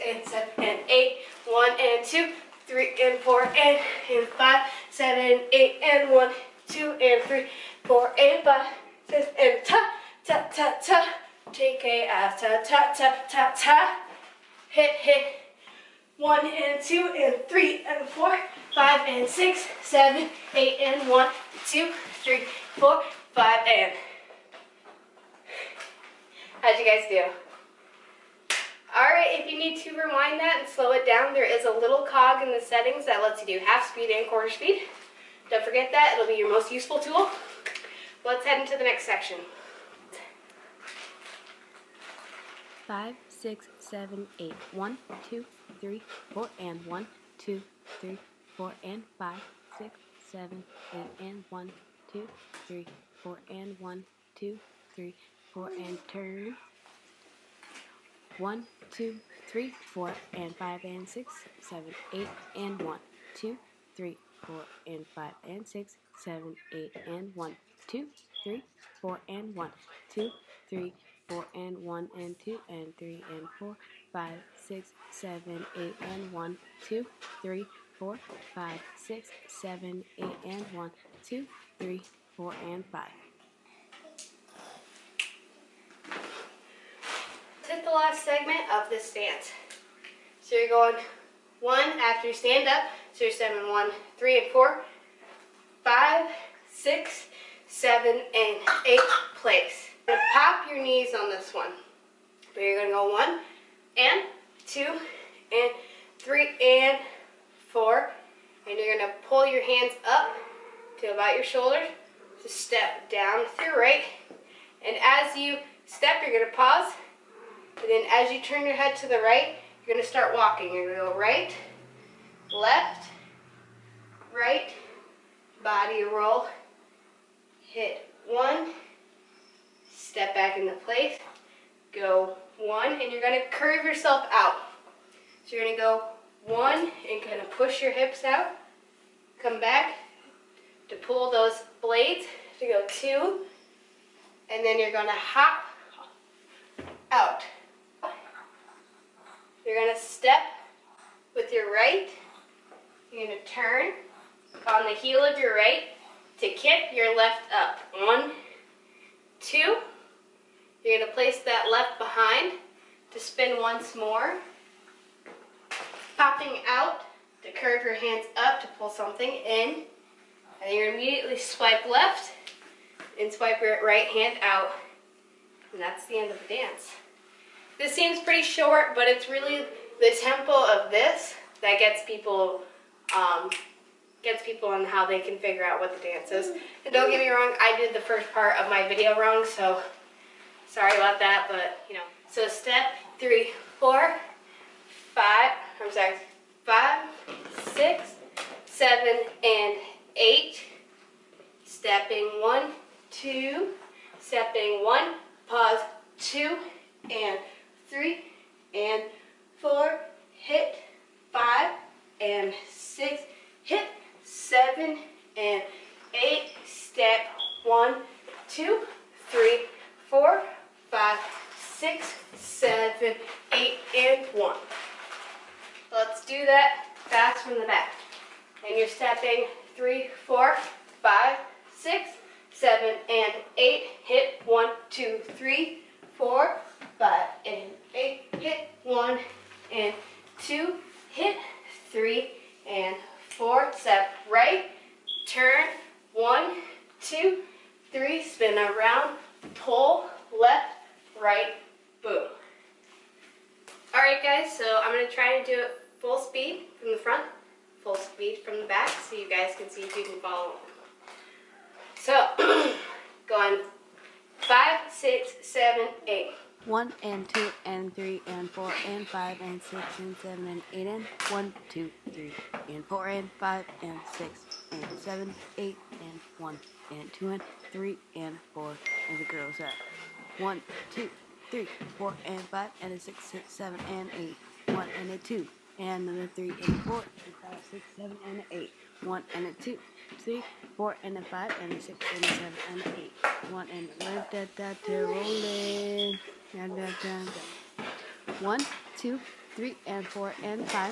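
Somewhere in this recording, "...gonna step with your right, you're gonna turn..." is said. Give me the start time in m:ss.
2:29.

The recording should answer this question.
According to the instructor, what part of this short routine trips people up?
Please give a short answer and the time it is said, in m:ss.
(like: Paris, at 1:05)
The tempo, at 3:00.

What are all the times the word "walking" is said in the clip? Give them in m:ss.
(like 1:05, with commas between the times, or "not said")
2:00.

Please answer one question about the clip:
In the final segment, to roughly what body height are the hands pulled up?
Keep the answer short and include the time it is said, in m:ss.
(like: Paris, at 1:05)
Shoulders, at 1:51.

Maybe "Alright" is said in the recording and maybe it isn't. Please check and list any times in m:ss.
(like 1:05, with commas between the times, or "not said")
0:28, 4:13.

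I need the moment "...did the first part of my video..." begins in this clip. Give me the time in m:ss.
3:07.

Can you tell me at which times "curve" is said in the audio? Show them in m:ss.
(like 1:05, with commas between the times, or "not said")
2:13, 2:47.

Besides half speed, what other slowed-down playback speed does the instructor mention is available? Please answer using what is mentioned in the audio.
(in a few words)
Quarter speed.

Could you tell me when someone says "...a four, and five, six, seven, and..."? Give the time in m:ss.
4:46.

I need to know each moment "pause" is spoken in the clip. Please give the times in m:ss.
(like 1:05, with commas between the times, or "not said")
1:56, 3:25.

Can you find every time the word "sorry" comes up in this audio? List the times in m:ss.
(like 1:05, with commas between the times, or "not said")
3:10, 3:15.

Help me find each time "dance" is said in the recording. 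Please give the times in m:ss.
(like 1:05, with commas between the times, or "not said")
1:29, 2:56, 3:06.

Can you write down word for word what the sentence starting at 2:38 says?
One, two, you're going to place that left behind to spin once more.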